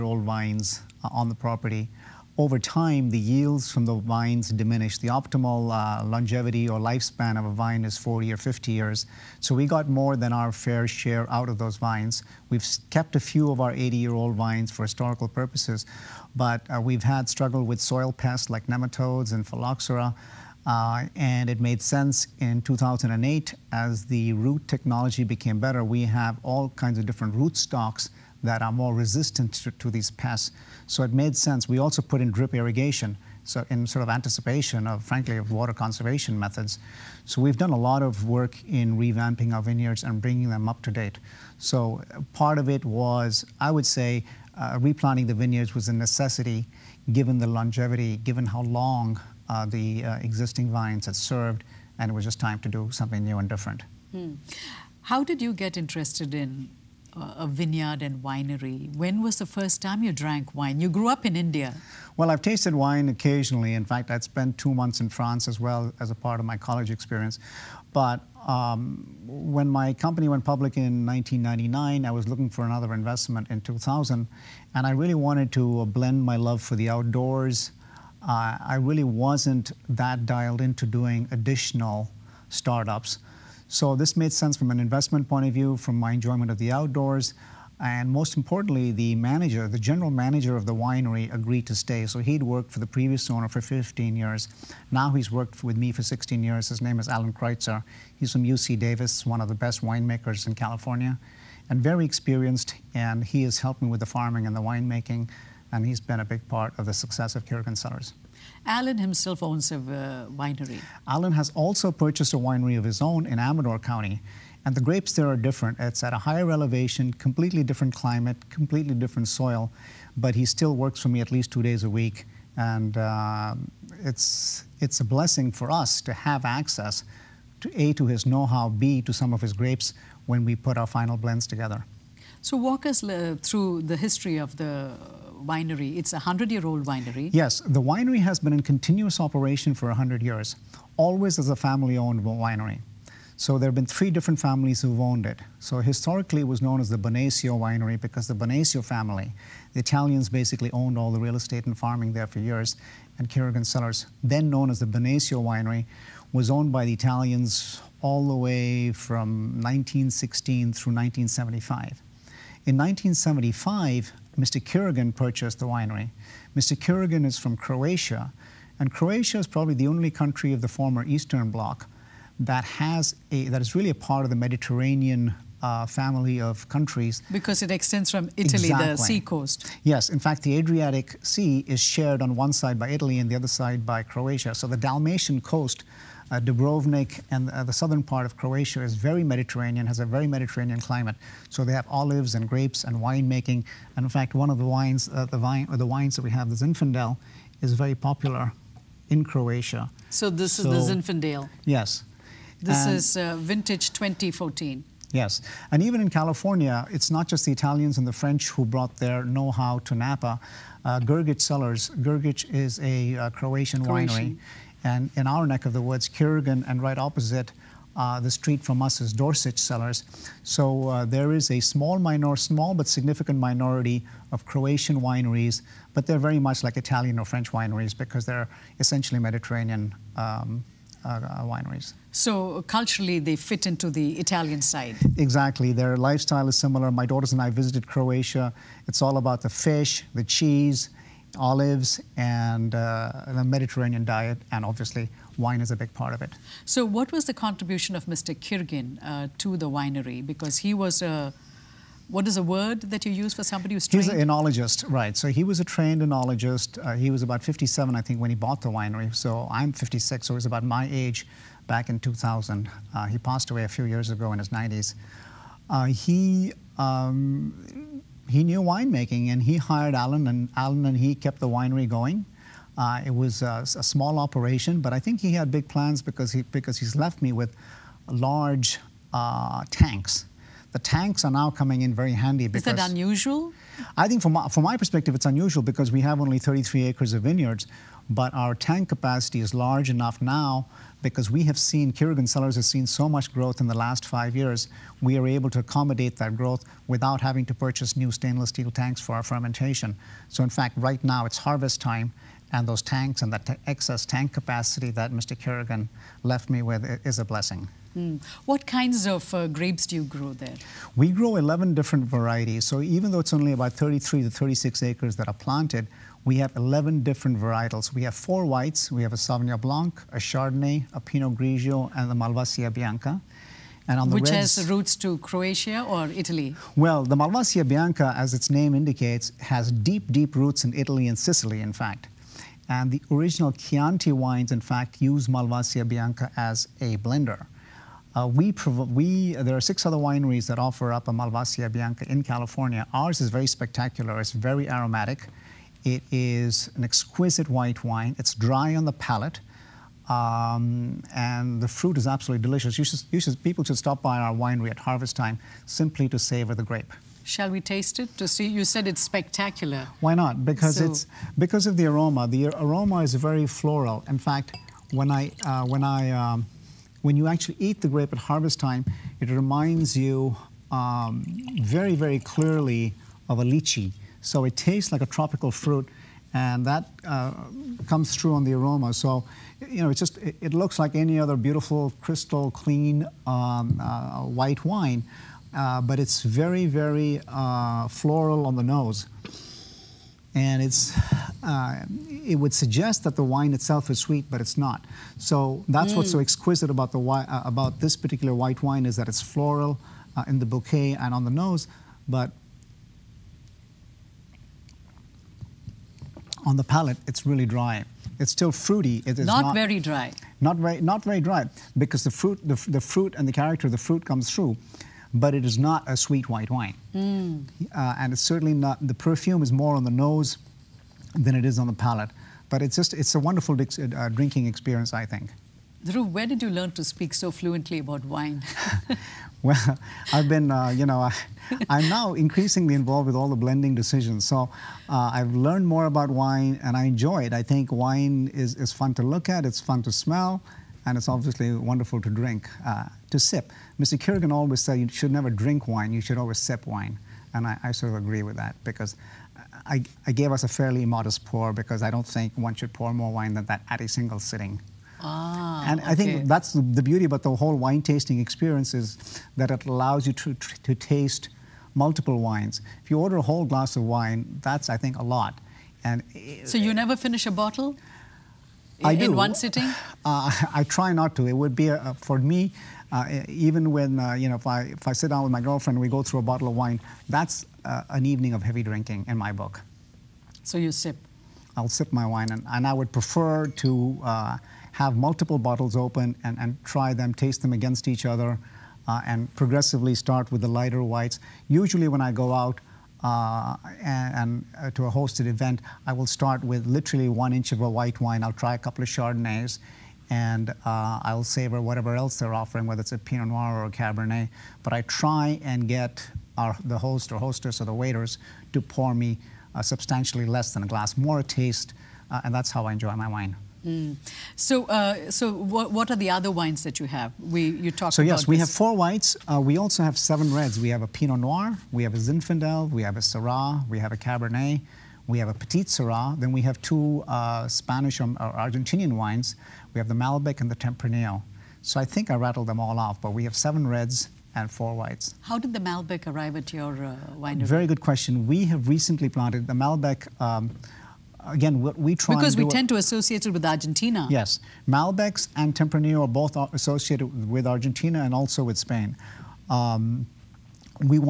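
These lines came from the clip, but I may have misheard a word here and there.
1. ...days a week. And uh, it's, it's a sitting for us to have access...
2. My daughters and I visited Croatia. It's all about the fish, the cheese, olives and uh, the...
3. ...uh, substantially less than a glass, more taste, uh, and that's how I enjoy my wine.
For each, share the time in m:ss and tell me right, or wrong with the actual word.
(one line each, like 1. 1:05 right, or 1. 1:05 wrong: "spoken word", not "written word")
1. 2:01 wrong: "blessing", not "sitting"
2. 3:56 right
3. 8:29 right.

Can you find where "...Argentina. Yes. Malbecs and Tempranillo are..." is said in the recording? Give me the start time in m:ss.
9:03.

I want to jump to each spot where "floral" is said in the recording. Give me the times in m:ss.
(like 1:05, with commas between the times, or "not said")
6:03, 6:27, 6:39.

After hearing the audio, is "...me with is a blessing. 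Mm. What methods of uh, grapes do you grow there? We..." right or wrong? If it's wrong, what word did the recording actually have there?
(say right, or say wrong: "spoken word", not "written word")
wrong: "kinds", not "methods".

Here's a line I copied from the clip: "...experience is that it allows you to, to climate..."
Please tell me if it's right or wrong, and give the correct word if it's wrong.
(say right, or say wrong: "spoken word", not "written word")
wrong: "taste", not "climate".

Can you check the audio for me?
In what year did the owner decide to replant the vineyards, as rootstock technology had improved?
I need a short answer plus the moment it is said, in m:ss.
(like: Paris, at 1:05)
2008, at 0:22.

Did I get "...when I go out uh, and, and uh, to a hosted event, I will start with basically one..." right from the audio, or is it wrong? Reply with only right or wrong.
wrong.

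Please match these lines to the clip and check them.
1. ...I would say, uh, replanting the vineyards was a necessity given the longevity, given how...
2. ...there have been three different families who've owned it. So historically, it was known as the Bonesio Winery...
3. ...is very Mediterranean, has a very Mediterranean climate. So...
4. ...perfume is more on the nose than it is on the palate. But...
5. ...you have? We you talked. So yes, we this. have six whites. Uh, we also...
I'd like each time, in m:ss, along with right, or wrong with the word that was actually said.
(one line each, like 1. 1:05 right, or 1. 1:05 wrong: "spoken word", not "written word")
1. 0:43 right
2. 2:23 right
3. 3:08 right
4. 6:58 right
5. 8:36 wrong: "four", not "six".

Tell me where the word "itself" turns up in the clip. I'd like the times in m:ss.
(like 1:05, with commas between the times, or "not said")
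6:33.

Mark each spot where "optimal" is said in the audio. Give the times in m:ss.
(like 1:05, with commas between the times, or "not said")
0:05.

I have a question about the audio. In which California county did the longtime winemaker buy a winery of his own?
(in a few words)
Amador County.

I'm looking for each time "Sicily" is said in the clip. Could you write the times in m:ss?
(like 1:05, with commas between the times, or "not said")
5:31.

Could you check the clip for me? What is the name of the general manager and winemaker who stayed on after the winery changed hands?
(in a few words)
Alan Kreutzer.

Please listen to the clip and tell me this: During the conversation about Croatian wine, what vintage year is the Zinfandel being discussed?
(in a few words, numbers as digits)
2014.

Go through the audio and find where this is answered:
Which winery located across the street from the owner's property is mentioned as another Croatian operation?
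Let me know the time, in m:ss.
3:39.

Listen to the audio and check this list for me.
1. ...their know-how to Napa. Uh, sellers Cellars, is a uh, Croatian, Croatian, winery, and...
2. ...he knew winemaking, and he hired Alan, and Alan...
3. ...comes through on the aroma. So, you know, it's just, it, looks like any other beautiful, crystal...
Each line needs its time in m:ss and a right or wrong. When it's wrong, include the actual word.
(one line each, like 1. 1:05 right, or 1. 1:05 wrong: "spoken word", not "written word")
1. 3:28 right
2. 4:28 right
3. 6:17 right.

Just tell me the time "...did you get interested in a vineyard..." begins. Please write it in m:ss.
0:55.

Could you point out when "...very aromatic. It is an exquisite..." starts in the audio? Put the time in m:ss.
5:44.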